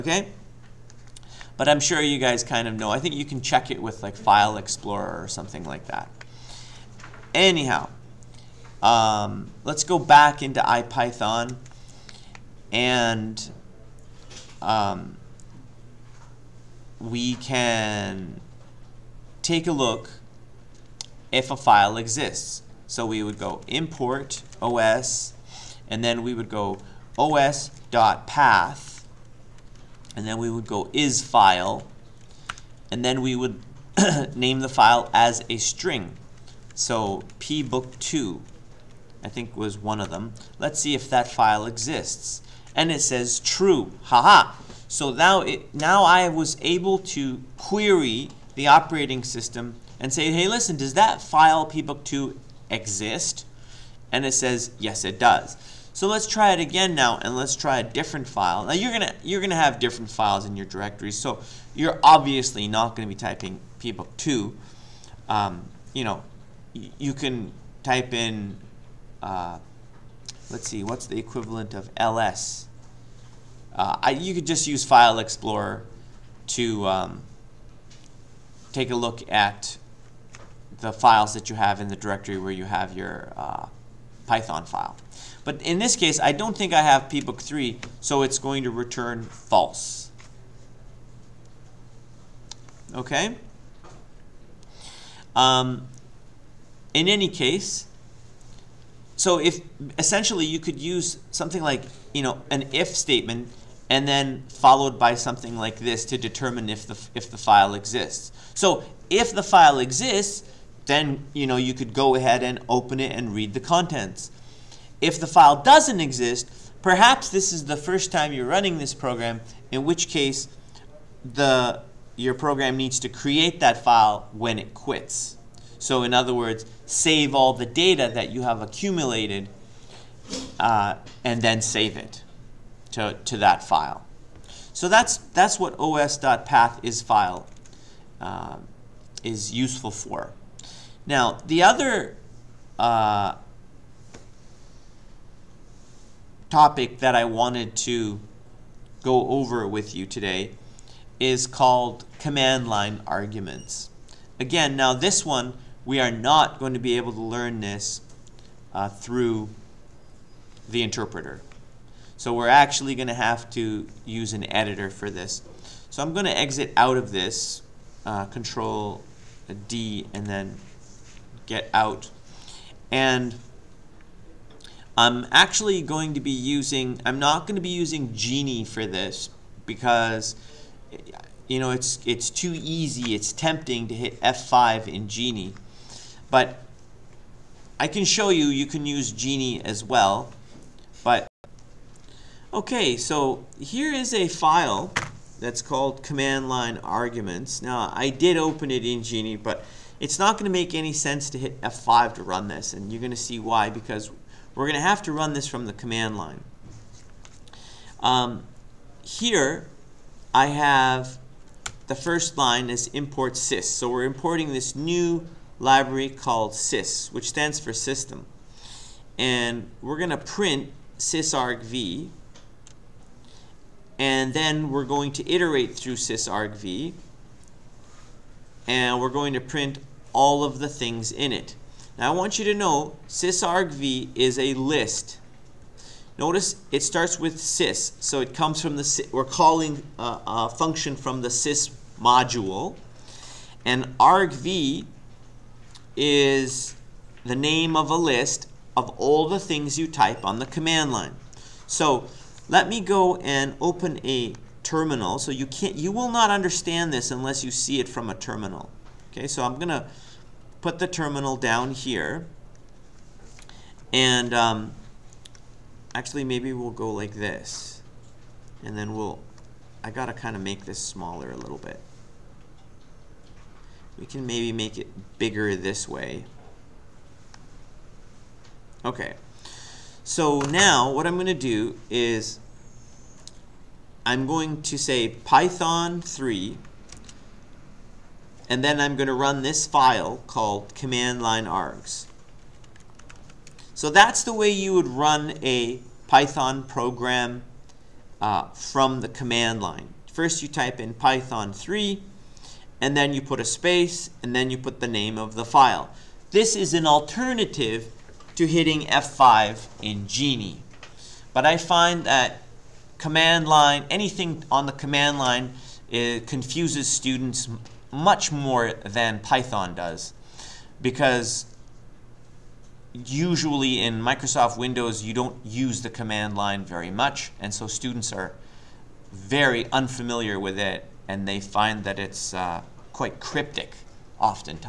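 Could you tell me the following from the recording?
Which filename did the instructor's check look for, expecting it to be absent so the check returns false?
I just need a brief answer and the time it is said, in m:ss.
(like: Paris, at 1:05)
pbook3, at 1:27.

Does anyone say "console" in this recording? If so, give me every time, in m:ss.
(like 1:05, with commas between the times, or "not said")
not said.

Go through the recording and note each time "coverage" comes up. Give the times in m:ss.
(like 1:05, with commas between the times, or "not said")
not said.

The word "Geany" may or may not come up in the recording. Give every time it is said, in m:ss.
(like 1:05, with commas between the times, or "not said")
2:58, 3:05, 3:09, 3:19, 5:10.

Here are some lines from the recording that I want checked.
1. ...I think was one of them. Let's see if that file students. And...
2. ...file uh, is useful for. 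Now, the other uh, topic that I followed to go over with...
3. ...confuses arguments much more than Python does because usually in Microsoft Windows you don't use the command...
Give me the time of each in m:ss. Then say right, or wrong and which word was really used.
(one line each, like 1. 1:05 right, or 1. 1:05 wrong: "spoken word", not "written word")
1. 0:39 wrong: "exists", not "students"
2. 2:17 wrong: "wanted", not "followed"
3. 5:15 wrong: "students", not "arguments".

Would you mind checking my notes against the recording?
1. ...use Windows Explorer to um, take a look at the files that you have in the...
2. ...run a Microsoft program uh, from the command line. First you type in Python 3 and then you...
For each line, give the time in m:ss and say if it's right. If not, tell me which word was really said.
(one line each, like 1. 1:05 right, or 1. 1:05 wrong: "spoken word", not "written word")
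1. 1:14 wrong: "File", not "Windows"
2. 4:54 wrong: "Python", not "Microsoft".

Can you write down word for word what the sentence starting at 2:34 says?
Again, now this one, we are not going to be able to learn this uh, through the interpreter.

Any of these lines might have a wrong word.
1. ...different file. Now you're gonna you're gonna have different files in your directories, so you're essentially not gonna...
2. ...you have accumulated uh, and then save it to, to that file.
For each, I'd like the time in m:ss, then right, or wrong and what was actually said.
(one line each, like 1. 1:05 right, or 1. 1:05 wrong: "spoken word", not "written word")
1. 0:57 wrong: "obviously", not "essentially"
2. 2:08 right.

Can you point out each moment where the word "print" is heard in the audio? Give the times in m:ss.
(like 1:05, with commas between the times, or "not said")
3:40, 3:49.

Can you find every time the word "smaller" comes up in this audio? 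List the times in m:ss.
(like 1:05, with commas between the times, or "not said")
4:30.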